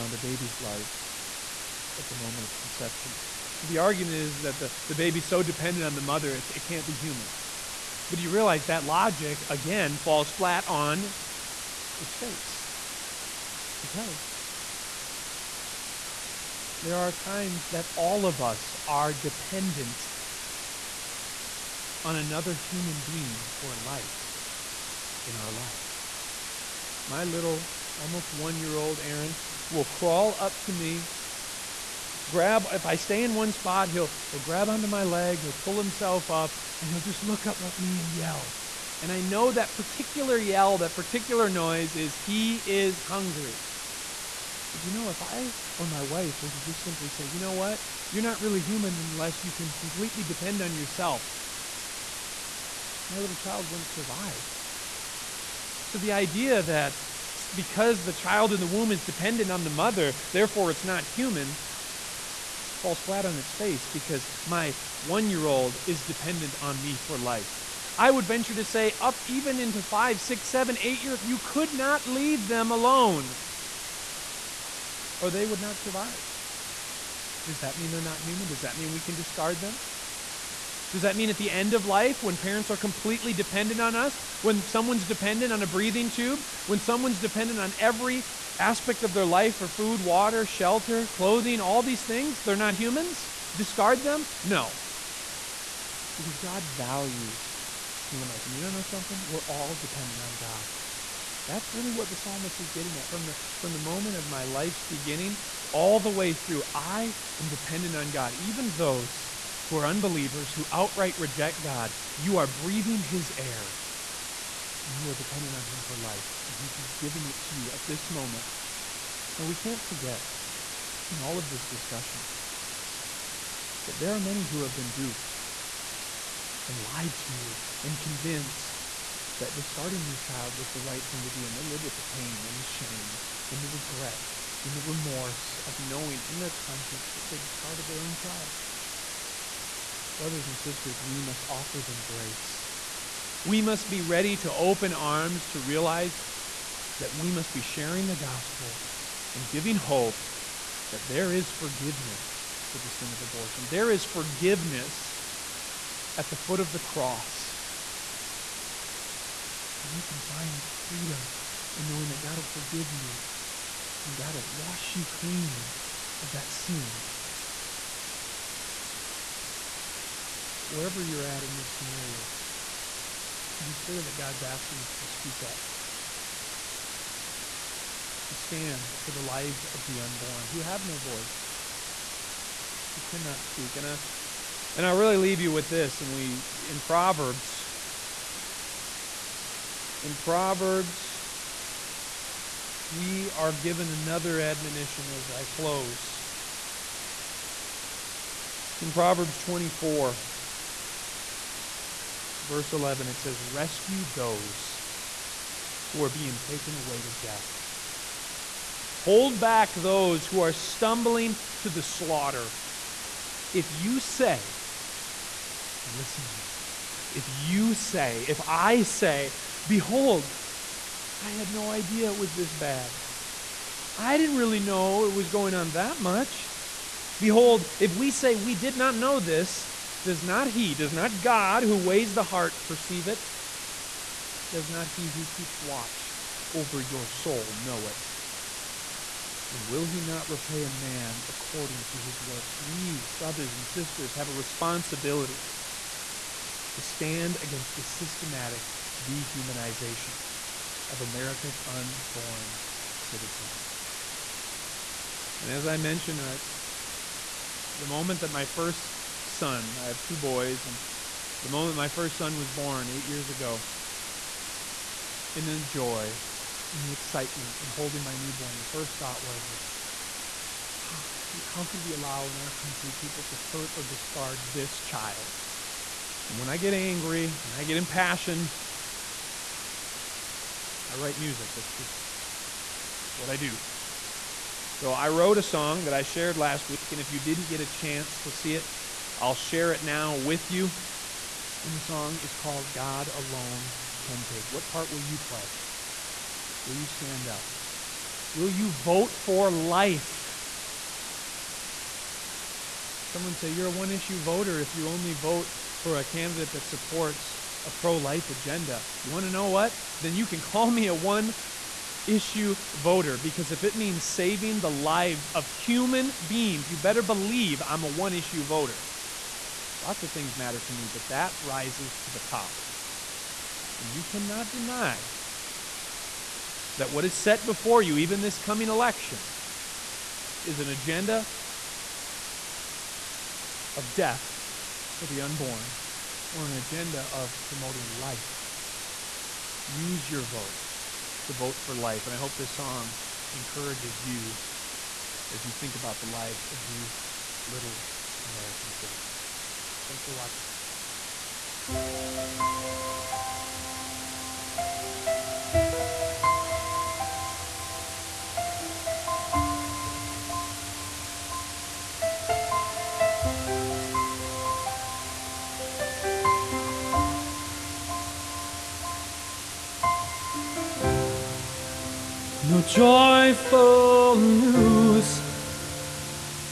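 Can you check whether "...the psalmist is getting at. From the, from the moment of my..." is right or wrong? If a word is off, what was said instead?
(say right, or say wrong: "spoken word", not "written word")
right.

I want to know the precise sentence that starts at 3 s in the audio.
So the argument is that the, the baby's so dependent on the mother, it can't be human.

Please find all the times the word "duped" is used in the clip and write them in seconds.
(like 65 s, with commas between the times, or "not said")
124 s.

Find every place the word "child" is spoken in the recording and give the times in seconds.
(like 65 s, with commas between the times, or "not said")
53 s, 58 s, 130 s, 138 s, 274 s.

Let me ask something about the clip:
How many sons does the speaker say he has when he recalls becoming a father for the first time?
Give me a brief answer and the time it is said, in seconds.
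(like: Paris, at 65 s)
2, at 260 s.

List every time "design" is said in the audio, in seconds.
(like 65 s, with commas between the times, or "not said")
not said.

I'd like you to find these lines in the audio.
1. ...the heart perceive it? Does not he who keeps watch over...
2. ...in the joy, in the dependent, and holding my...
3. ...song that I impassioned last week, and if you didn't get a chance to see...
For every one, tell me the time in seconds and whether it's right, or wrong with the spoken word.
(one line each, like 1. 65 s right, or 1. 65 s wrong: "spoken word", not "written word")
1. 232 s right
2. 265 s wrong: "excitement", not "dependent"
3. 285 s wrong: "shared", not "impassioned".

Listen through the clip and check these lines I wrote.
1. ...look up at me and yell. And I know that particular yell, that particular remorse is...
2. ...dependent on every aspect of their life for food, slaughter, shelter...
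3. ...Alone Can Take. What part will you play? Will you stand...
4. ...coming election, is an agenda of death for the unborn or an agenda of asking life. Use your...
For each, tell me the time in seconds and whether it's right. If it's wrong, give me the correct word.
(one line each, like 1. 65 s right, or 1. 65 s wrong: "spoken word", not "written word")
1. 37 s wrong: "noise", not "remorse"
2. 87 s wrong: "water", not "slaughter"
3. 293 s right
4. 328 s wrong: "promoting", not "asking".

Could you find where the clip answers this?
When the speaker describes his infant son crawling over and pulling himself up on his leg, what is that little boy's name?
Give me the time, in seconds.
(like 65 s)
29 s.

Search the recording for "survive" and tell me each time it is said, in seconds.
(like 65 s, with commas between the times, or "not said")
53 s, 75 s.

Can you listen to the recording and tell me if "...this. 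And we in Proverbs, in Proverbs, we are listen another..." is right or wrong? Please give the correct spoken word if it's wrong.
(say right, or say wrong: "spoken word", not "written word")
wrong: "given", not "listen".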